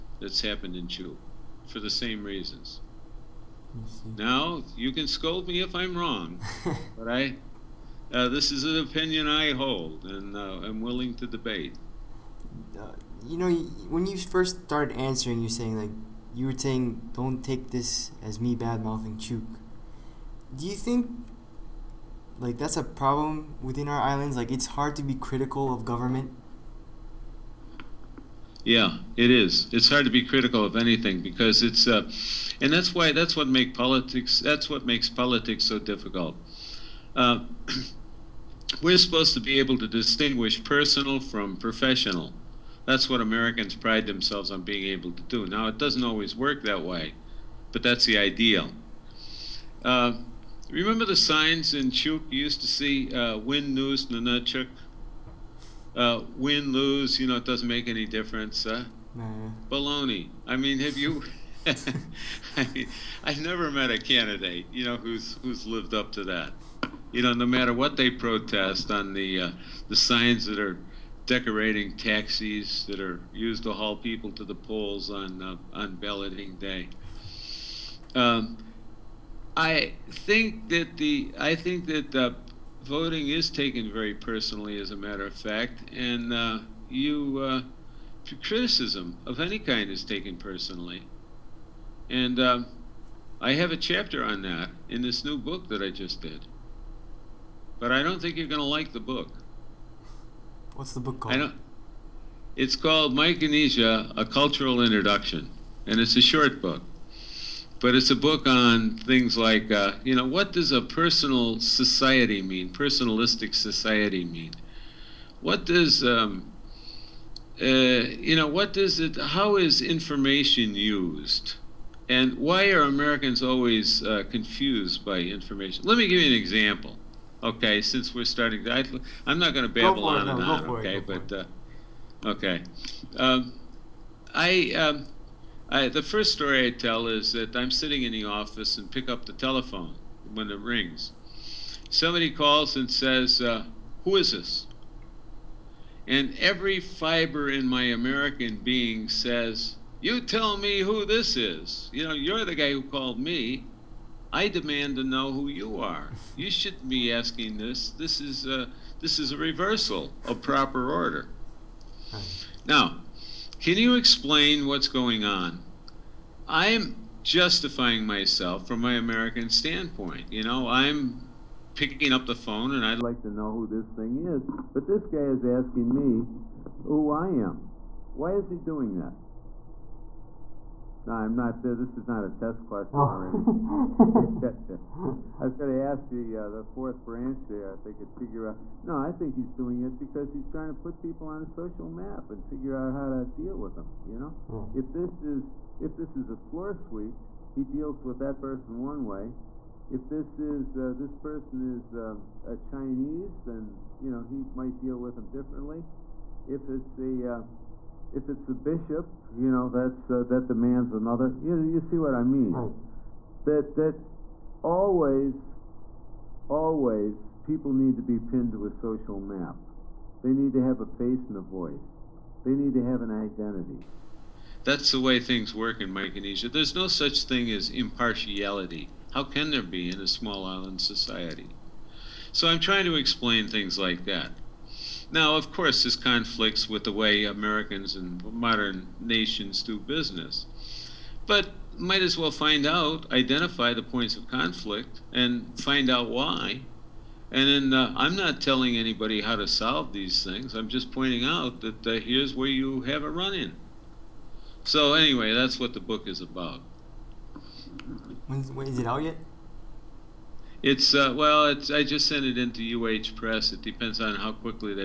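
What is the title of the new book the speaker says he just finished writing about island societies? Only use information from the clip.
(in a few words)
Micronesia: A Cultural Introduction.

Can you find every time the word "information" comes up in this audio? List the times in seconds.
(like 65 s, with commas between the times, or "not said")
119 s, 125 s.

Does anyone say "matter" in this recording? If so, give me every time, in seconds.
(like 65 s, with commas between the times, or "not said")
67 s, 84 s.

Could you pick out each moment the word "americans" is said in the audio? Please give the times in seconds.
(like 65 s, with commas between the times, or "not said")
43 s, 122 s, 147 s, 168 s, 237 s.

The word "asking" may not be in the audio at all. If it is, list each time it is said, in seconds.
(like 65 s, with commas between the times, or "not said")
157 s, 175 s.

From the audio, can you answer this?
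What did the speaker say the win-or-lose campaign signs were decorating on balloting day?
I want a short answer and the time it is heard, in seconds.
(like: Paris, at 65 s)
Taxis, at 71 s.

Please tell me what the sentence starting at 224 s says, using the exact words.
That's the way things work in Micronesia.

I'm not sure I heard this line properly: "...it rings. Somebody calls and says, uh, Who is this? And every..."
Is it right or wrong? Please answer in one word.
right.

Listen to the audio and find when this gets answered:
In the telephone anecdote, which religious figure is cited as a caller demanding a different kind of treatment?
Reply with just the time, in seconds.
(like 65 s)
208 s.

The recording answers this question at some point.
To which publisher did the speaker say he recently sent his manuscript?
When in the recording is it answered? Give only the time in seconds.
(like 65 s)
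262 s.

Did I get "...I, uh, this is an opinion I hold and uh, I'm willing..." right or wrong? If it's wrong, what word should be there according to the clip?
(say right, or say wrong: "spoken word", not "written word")
right.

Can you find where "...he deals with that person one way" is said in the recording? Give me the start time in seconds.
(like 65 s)
197 s.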